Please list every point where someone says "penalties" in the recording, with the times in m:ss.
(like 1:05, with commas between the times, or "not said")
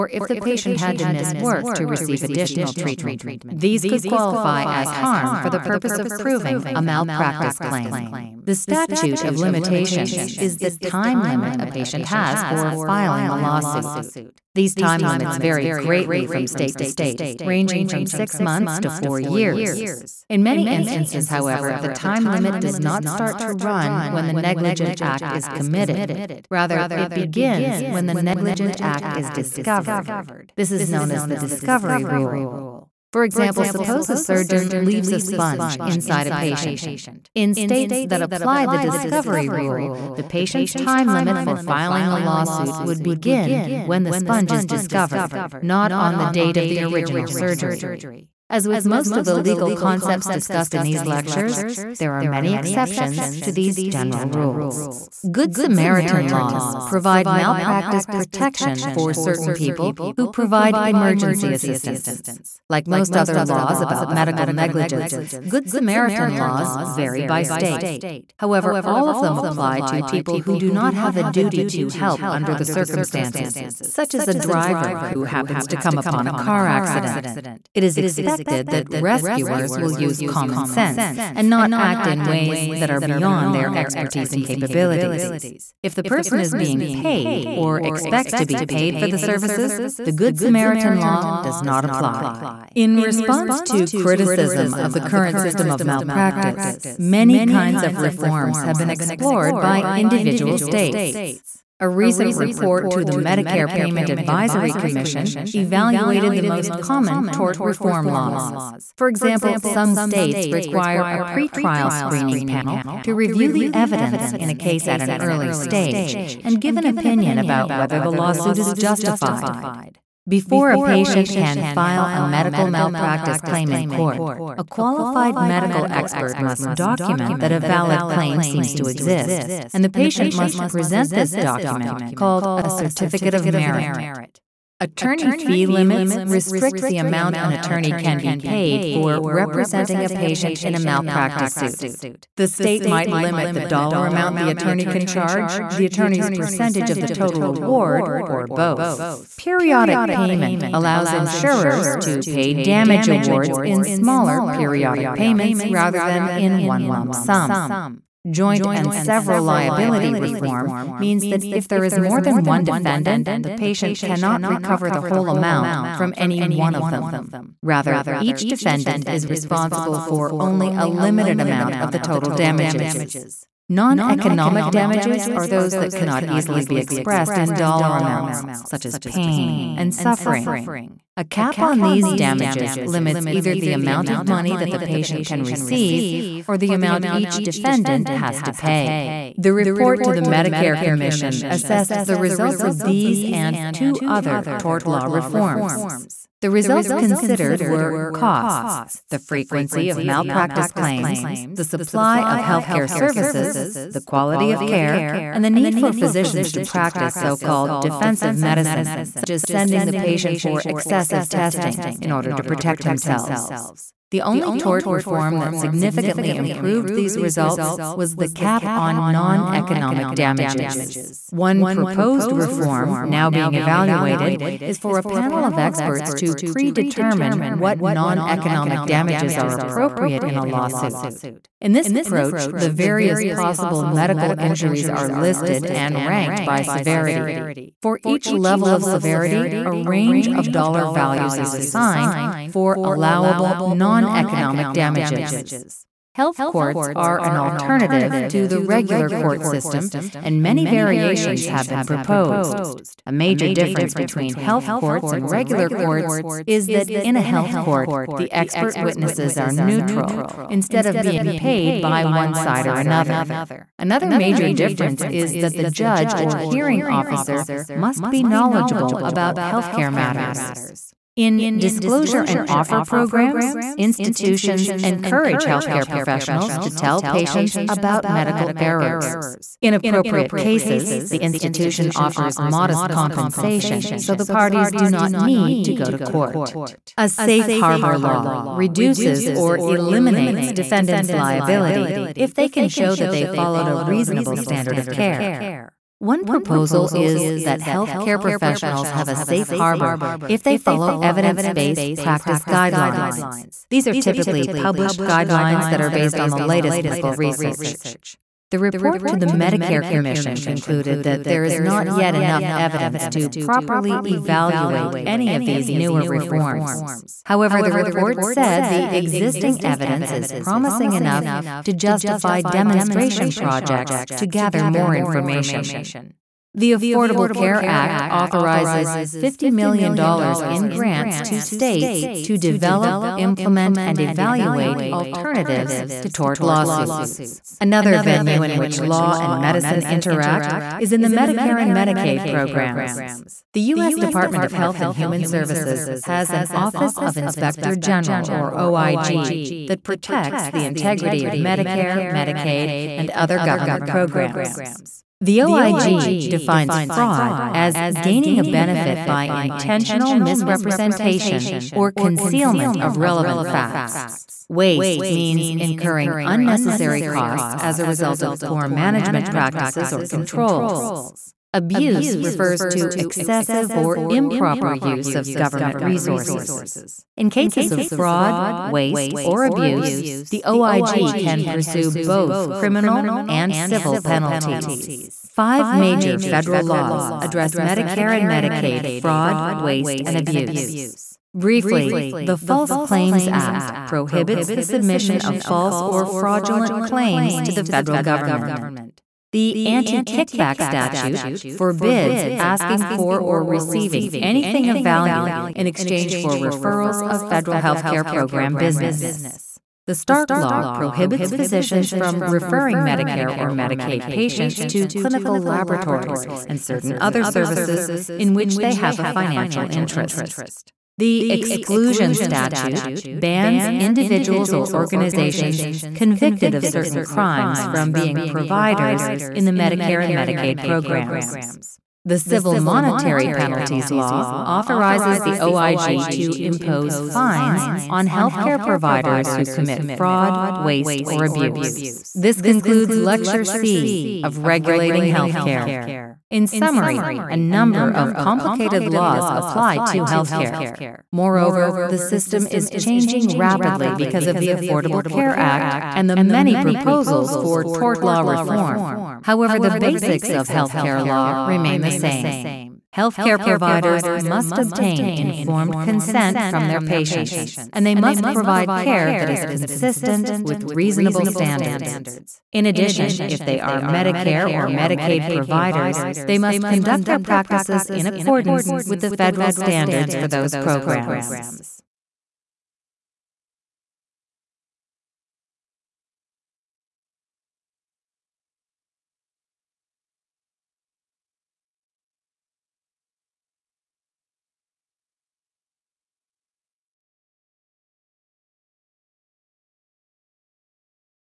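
6:23, 7:13.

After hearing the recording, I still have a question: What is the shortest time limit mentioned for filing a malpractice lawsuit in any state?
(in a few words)
6 months.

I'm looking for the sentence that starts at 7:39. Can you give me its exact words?
However, the basics of healthcare law remain the same.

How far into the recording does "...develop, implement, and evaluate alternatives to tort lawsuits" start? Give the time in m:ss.
5:32.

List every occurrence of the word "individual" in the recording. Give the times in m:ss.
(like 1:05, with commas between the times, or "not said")
1:39, 7:03.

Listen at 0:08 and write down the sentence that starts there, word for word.
The statute of limitations is the time limit a patient has for filing a lawsuit.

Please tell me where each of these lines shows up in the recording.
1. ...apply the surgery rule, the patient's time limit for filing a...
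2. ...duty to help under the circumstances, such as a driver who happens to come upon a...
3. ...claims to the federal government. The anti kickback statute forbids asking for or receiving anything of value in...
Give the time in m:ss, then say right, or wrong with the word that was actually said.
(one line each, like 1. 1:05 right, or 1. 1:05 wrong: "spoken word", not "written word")
1. 0:38 wrong: "discovery", not "surgery"
2. 1:11 right
3. 6:36 right.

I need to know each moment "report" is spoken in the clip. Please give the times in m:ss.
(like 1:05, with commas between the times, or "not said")
1:42, 3:09, 5:08, 5:17.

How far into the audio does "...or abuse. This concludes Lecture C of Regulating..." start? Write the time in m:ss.
7:21.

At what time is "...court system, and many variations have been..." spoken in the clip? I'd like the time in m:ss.
4:09.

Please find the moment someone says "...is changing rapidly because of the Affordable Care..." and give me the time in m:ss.
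7:32.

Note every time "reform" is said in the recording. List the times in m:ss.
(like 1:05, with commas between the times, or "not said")
1:37, 1:47, 2:40, 3:15, 3:34, 3:42, 5:16, 7:38.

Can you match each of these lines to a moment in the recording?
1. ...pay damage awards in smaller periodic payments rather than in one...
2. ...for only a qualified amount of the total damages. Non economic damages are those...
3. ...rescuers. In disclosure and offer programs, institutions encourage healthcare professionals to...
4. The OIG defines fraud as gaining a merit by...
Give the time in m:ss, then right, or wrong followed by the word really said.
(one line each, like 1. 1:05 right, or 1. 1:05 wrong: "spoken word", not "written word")
1. 2:32 right
2. 2:50 wrong: "limited", not "qualified"
3. 4:29 wrong: "matters", not "rescuers"
4. 5:55 wrong: "benefit", not "merit".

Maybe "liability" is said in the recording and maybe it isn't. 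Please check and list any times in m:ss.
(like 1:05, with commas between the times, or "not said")
2:39, 4:51.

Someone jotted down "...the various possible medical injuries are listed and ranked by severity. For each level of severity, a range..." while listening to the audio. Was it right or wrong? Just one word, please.
right.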